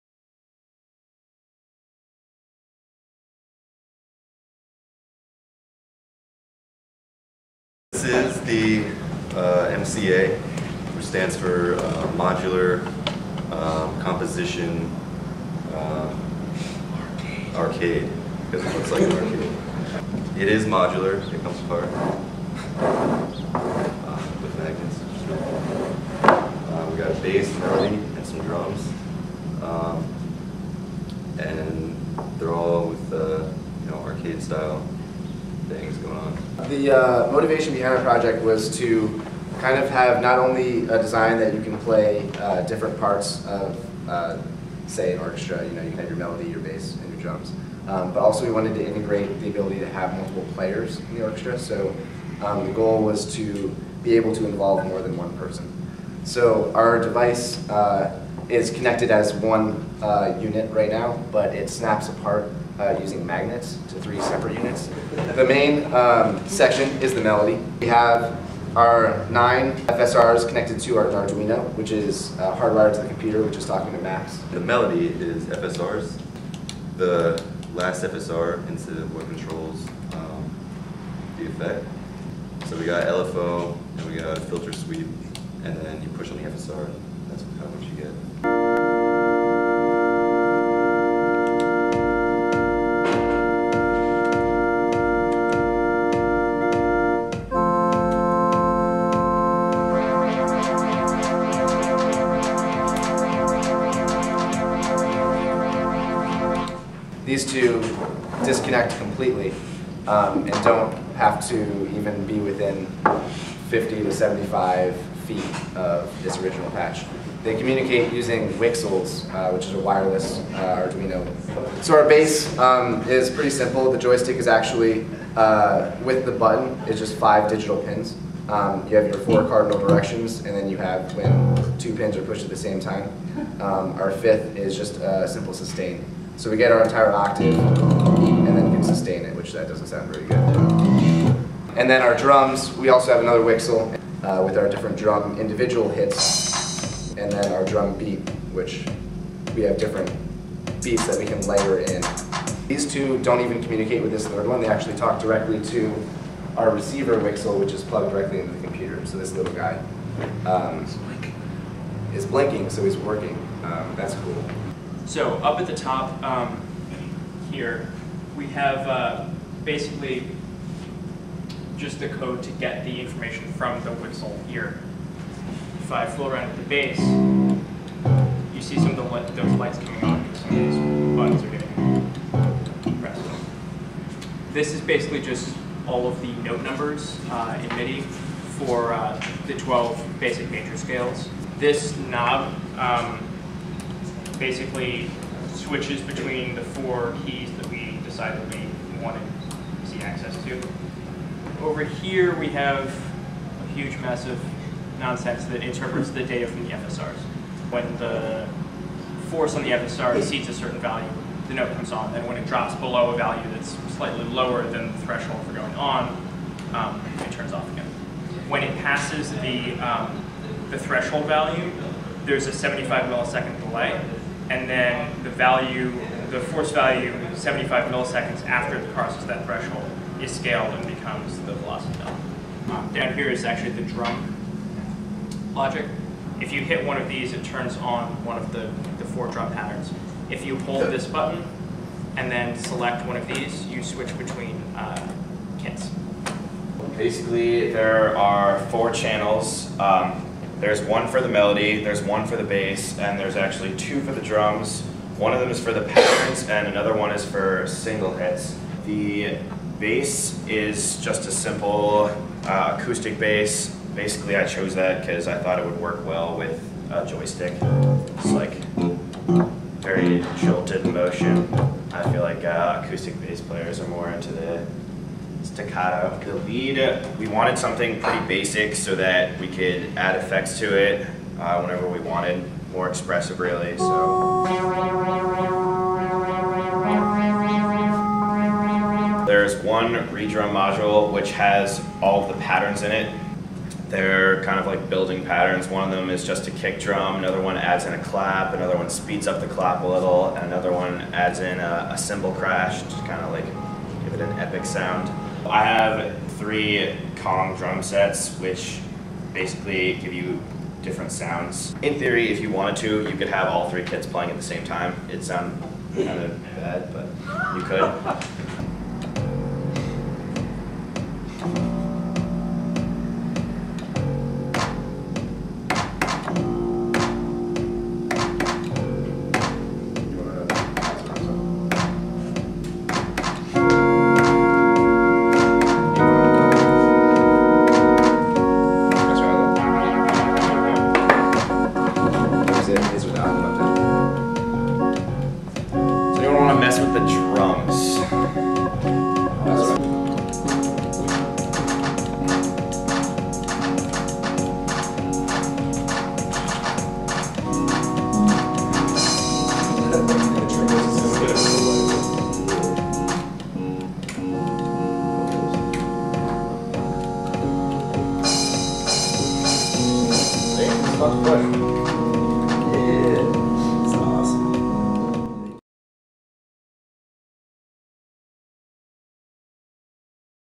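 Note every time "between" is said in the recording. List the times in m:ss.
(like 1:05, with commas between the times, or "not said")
3:16, 4:04.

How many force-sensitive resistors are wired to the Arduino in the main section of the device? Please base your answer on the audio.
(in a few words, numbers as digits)
9.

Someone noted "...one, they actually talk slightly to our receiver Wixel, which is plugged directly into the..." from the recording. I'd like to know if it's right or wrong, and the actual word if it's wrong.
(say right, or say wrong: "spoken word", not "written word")
wrong: "directly", not "slightly".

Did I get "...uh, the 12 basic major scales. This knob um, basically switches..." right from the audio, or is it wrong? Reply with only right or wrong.
right.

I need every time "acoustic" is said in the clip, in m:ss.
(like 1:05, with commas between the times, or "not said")
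4:22, 4:32.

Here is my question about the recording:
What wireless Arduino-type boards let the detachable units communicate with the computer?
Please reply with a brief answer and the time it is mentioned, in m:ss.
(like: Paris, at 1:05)
Wixels, at 1:58.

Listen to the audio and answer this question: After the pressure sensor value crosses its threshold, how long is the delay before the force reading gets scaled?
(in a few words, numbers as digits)
75 milliseconds.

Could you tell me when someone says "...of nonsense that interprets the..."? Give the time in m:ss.
3:24.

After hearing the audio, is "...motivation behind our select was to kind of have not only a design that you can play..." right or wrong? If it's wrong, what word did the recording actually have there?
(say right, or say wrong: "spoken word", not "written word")
wrong: "project", not "select".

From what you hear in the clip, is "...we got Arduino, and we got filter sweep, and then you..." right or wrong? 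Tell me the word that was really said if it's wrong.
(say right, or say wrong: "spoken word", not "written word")
wrong: "LFO", not "Arduino".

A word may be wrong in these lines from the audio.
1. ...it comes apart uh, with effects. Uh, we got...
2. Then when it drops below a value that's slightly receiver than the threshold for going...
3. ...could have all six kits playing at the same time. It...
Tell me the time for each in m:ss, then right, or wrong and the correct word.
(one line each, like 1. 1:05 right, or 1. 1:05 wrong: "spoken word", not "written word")
1. 0:21 wrong: "magnets", not "effects"
2. 3:32 wrong: "lower", not "receiver"
3. 5:13 wrong: "three", not "six".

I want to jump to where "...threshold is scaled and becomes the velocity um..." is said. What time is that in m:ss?
3:49.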